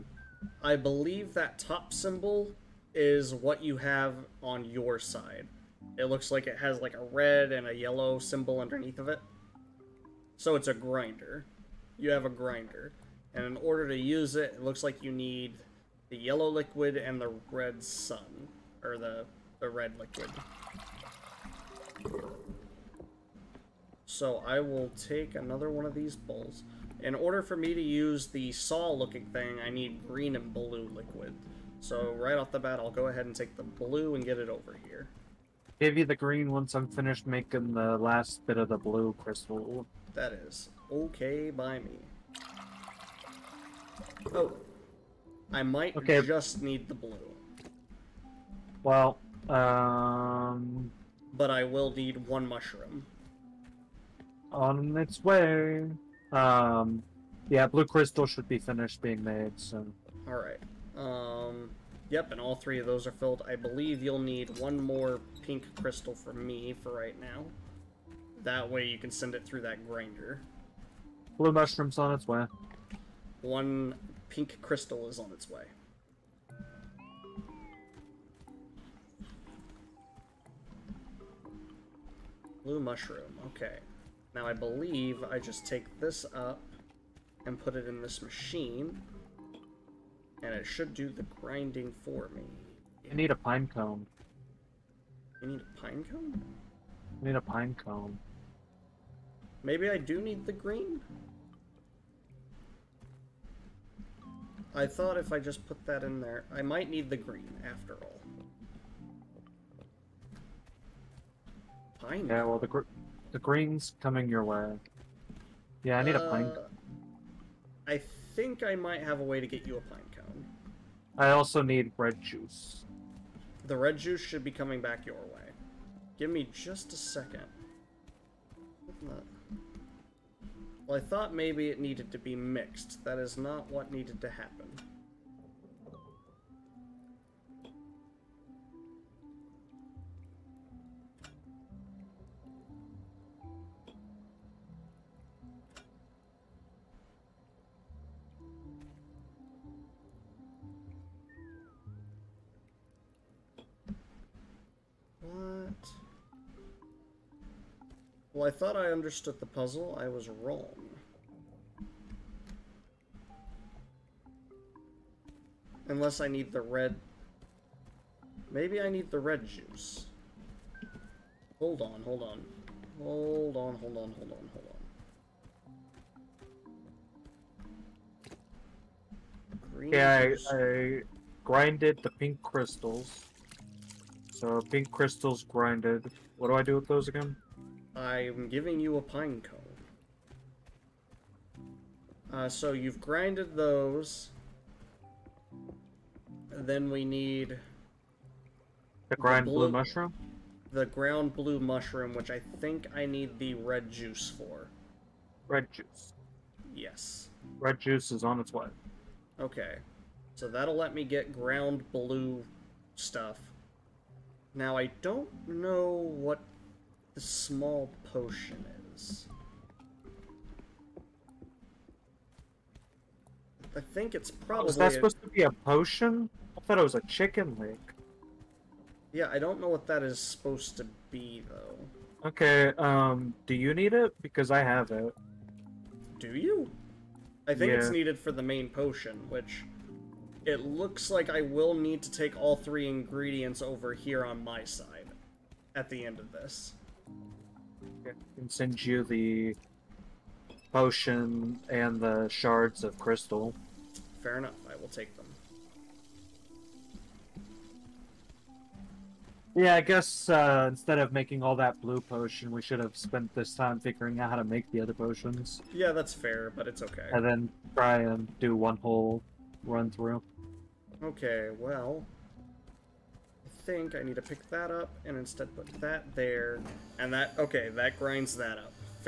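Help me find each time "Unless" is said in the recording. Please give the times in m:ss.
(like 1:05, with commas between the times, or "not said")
2:45.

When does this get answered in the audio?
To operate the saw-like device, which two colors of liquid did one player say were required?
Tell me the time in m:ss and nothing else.
0:30.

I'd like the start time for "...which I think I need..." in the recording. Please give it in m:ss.
3:22.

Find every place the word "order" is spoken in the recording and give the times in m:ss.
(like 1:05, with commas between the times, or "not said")
0:13, 0:27.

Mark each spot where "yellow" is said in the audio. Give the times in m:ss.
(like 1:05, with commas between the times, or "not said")
0:07, 0:16.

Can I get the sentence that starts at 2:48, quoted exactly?
Maybe I need the red juice.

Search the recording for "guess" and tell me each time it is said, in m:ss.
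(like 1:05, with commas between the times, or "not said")
4:19.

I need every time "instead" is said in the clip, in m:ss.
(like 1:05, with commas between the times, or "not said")
4:20, 4:35.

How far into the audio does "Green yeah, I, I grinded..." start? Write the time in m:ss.
2:59.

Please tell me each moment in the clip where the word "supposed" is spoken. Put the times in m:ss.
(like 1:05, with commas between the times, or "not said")
3:44, 3:50.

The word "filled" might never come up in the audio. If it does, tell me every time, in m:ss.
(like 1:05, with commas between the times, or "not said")
1:03.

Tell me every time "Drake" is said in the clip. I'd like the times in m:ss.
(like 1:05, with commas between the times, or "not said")
not said.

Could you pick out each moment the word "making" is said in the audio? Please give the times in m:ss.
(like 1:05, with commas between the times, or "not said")
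0:37, 4:21.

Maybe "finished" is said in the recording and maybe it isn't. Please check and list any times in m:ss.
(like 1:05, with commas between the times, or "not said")
0:36, 0:58.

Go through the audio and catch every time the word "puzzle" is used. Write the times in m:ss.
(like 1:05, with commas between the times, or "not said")
2:39.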